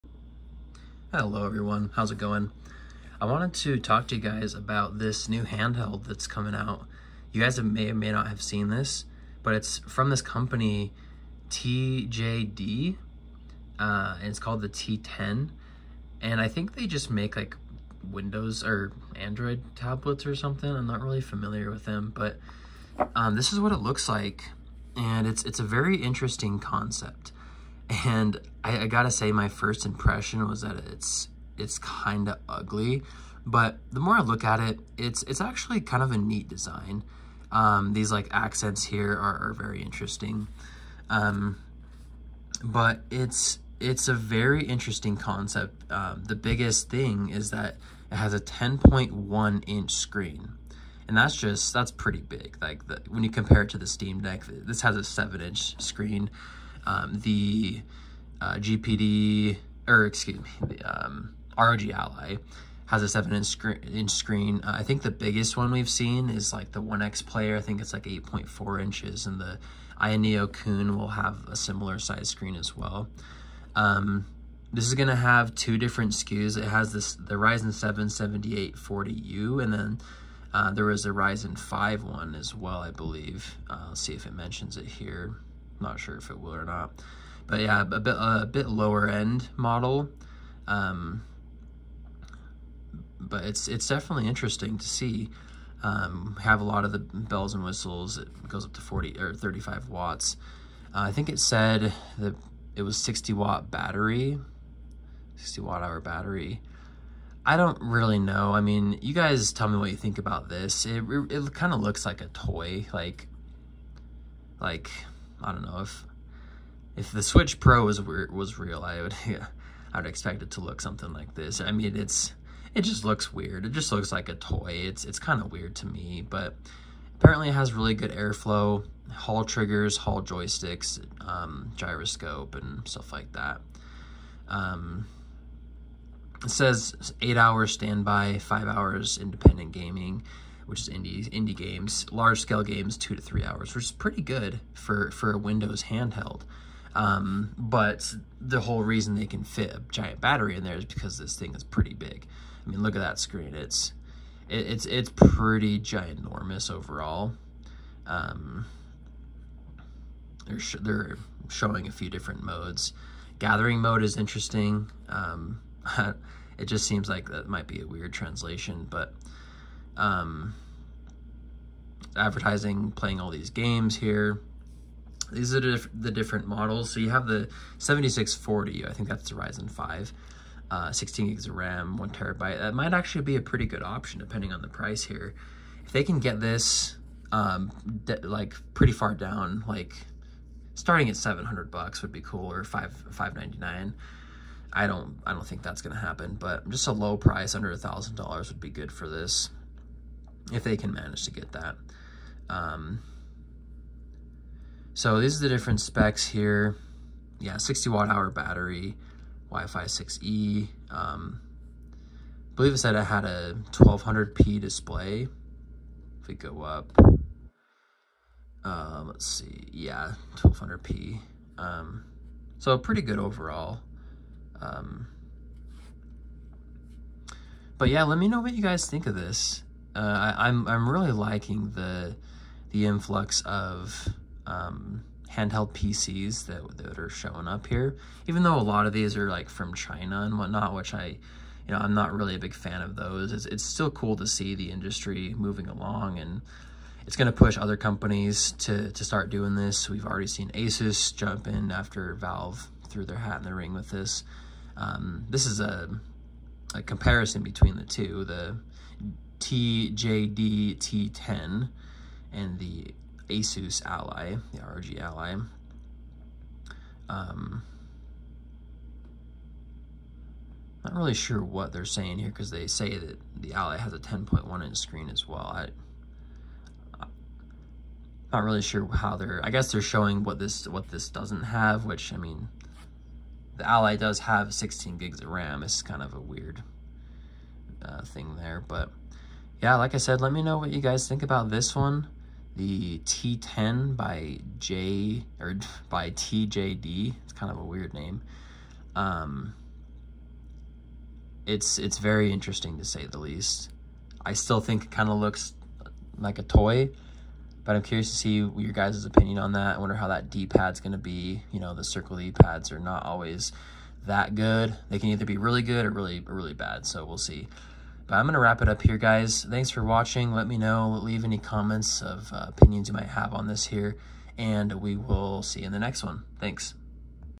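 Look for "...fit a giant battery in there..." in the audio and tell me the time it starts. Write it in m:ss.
2:29.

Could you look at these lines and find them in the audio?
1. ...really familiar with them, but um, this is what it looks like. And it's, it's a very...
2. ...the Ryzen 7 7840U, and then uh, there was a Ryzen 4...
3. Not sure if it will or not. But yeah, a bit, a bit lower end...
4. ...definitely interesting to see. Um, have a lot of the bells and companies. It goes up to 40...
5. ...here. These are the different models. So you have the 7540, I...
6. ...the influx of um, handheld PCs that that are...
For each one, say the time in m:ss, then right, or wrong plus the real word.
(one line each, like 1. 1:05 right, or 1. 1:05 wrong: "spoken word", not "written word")
1. 0:21 right
2. 1:17 wrong: "5", not "4"
3. 1:25 right
4. 1:33 wrong: "whistles", not "companies"
5. 2:53 wrong: "7640", not "7540"
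6. 3:52 right.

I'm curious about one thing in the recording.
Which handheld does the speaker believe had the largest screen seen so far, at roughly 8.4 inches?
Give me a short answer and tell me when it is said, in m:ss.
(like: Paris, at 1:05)
OneXPlayer, at 1:06.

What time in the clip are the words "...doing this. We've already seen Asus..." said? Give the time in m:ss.
4:09.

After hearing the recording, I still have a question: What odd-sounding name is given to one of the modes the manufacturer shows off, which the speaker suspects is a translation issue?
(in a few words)
Gathering mode.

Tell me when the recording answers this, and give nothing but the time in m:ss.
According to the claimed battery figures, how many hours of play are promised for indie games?
2:18.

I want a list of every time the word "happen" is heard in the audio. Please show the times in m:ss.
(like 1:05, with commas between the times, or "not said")
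3:16.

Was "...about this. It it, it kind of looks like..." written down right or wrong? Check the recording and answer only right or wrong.
right.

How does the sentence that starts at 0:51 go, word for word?
And that's just, that's pretty big.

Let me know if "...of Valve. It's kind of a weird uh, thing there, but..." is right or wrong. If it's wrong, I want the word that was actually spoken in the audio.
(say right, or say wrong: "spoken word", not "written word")
wrong: "RAM", not "Valve".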